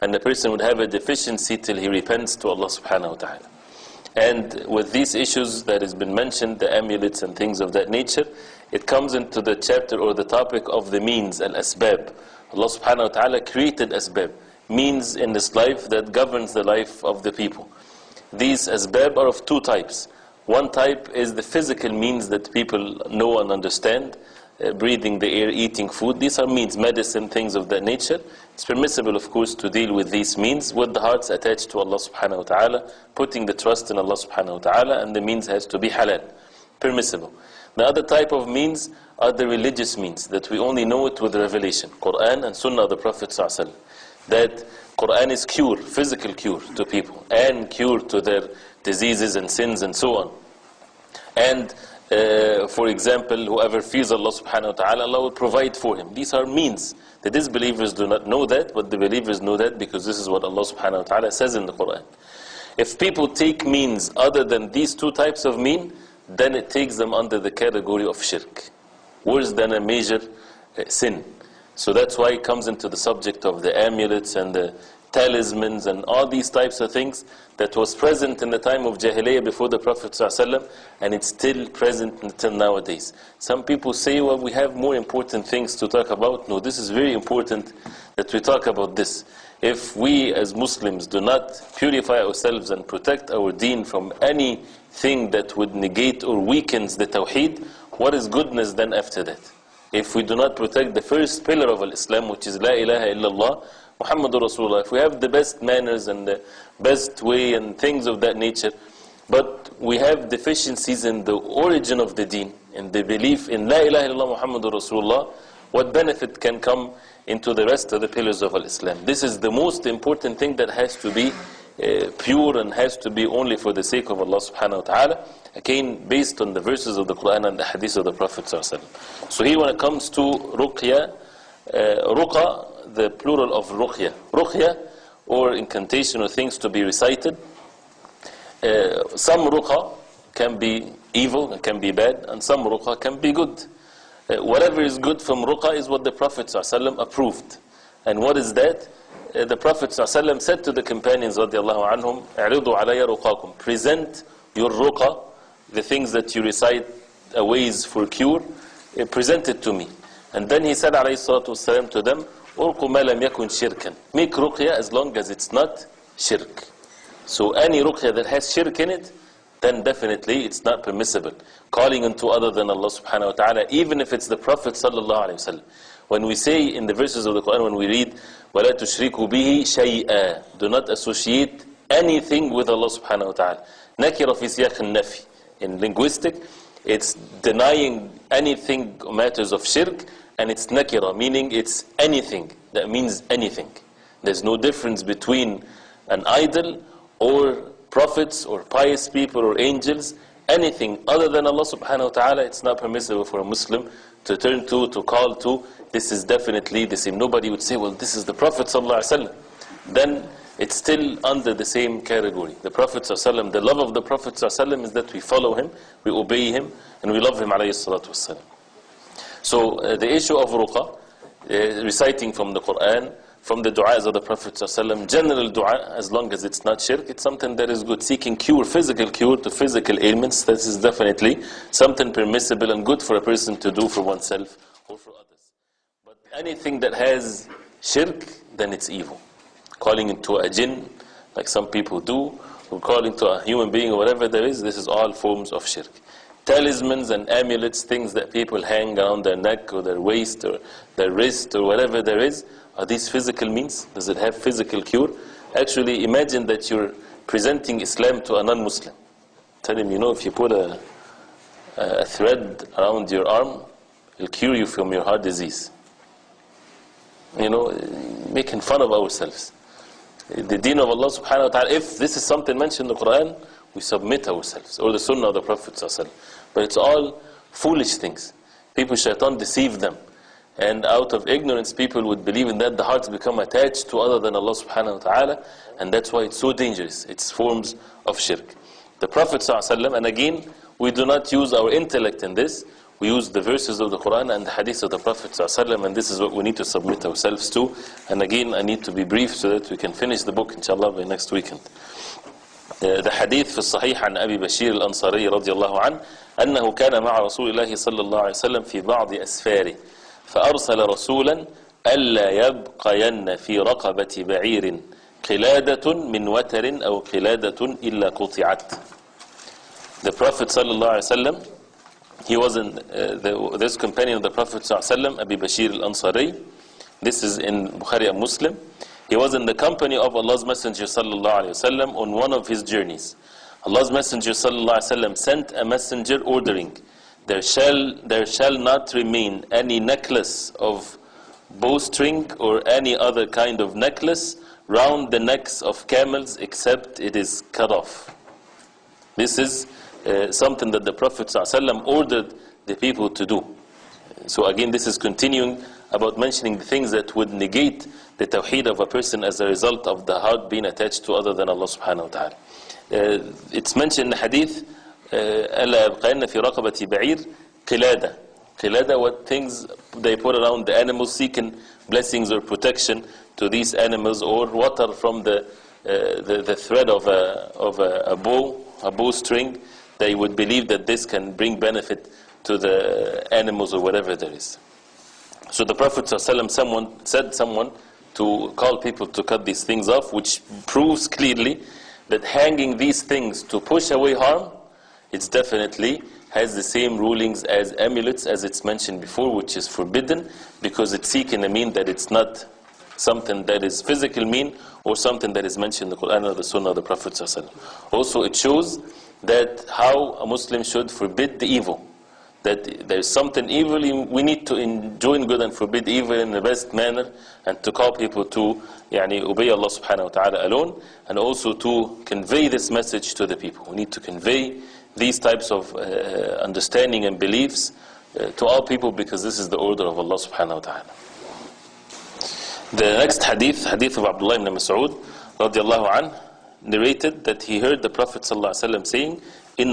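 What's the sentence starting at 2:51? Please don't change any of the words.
Calling unto other than Allah subhanahu wa ta'ala, even if it's the Prophet sallallahu alayhi wa sallam.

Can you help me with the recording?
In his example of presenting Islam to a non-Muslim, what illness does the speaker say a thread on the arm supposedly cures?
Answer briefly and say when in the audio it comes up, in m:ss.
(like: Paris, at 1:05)
heart disease, at 4:25.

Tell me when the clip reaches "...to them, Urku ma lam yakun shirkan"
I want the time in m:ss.
2:41.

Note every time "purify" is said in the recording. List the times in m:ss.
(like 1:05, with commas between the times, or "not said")
1:31.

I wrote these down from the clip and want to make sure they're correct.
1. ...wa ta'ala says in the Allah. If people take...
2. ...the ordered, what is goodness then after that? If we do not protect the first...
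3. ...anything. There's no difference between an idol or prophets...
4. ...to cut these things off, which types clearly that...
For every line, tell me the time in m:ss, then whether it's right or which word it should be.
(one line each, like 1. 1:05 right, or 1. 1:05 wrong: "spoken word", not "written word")
1. 1:00 wrong: "Quran", not "Allah"
2. 1:36 wrong: "tawheed", not "ordered"
3. 3:13 right
4. 6:29 wrong: "proves", not "types".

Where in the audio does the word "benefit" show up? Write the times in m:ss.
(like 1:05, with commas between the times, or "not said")
1:55, 6:21.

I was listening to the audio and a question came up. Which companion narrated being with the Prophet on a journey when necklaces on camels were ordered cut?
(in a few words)
Abi Bashir al-Ansari.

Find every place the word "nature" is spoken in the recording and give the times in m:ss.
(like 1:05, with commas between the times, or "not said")
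0:07, 0:27, 1:48.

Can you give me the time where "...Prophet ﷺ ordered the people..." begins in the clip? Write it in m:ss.
5:50.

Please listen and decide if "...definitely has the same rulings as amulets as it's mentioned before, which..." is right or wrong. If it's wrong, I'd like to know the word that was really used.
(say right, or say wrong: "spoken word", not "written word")
right.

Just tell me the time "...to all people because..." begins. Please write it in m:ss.
7:08.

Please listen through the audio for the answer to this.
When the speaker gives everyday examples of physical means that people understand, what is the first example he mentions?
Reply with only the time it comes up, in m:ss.
0:24.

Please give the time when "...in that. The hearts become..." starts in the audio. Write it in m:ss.
4:42.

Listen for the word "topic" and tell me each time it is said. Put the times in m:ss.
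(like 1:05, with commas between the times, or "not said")
0:10.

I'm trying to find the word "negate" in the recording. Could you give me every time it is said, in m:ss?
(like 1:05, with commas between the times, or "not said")
1:35, 5:57.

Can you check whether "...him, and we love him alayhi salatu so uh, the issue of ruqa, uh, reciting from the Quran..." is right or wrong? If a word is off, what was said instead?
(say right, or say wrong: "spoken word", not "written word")
right.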